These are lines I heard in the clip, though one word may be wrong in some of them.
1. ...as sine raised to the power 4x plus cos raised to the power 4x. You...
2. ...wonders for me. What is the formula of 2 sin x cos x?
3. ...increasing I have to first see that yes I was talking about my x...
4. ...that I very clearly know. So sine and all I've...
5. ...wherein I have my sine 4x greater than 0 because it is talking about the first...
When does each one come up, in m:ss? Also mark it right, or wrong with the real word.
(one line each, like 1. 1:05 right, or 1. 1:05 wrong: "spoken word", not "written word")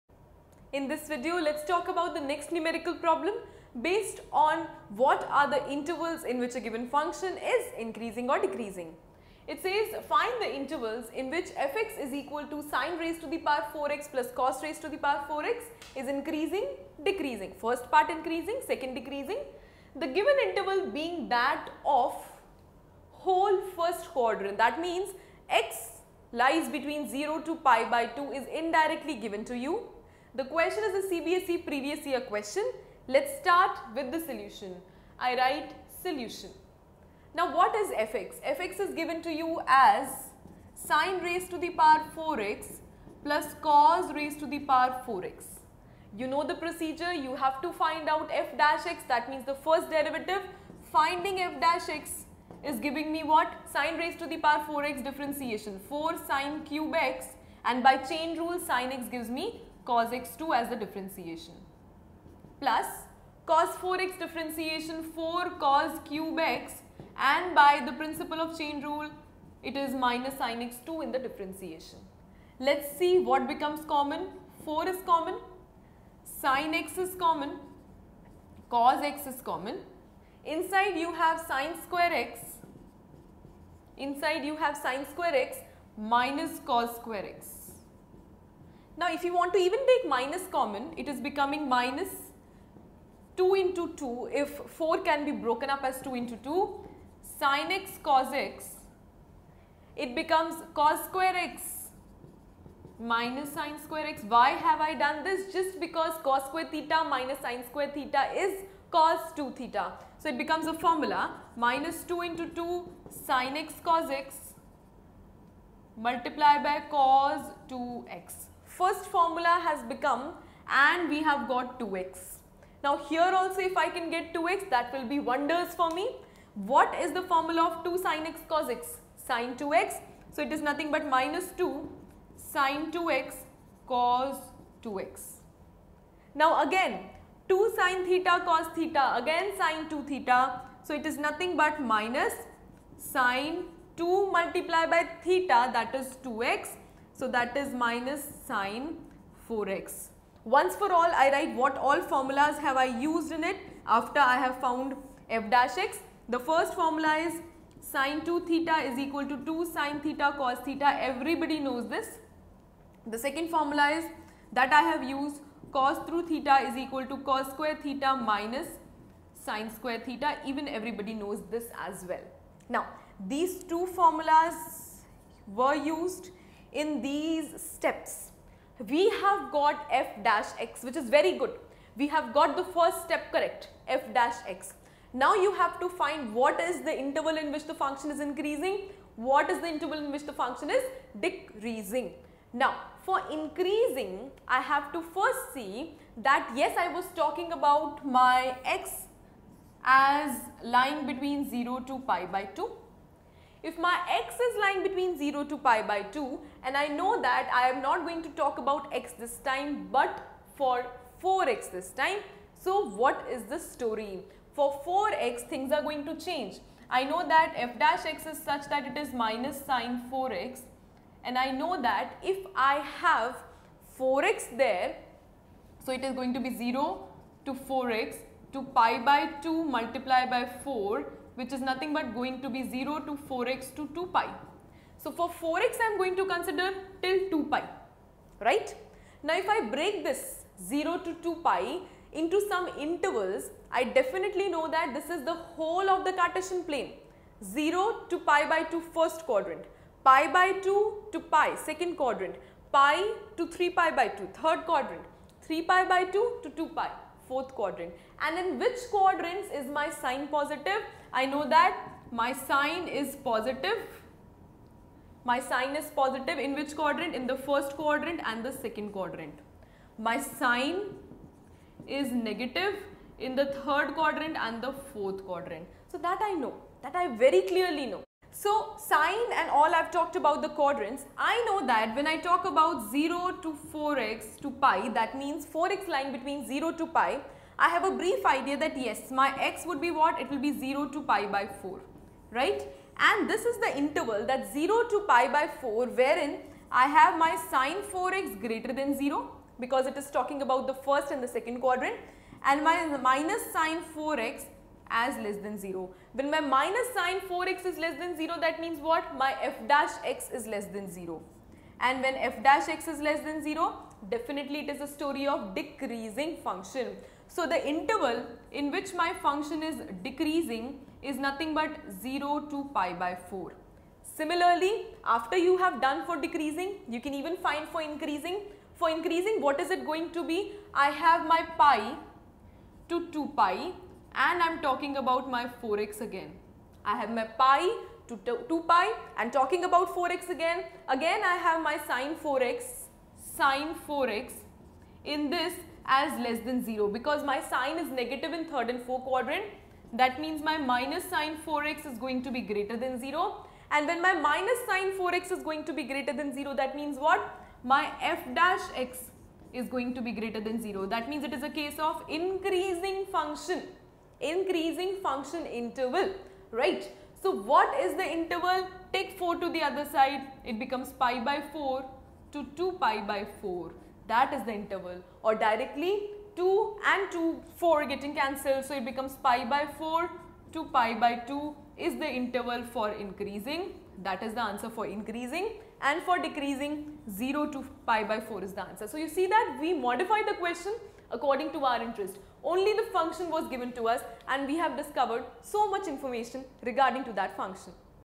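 1. 0:39 right
2. 2:05 right
3. 3:13 right
4. 4:36 right
5. 4:55 right.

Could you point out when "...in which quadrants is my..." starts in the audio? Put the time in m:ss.
4:18.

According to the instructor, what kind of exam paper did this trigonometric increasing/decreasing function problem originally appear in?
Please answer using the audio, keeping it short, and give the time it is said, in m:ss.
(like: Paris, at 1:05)
CBSE previous year question, at 0:31.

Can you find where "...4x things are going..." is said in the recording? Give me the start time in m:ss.
3:34.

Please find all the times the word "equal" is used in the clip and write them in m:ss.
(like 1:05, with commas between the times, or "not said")
0:12, 2:38, 2:46.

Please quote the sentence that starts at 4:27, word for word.
In the first quadrant and the second quadrant.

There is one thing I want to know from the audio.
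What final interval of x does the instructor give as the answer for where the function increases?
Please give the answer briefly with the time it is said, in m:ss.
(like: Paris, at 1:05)
pi by 4 to pi by 2, at 6:19.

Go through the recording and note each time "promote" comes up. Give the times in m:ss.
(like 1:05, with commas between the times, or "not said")
not said.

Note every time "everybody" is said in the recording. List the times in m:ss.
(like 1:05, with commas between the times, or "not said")
2:41, 2:50.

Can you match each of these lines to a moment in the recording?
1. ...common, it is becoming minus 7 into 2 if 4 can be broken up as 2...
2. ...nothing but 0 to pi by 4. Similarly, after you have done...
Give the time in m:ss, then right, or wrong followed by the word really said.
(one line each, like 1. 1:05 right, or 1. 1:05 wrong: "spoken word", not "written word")
1. 1:30 wrong: "2", not "7"
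2. 5:21 right.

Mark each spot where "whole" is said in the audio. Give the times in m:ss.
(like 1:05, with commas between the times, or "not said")
0:23, 4:05.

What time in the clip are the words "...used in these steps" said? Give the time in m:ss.
2:55.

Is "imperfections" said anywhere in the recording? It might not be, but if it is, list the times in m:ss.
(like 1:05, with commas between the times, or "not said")
not said.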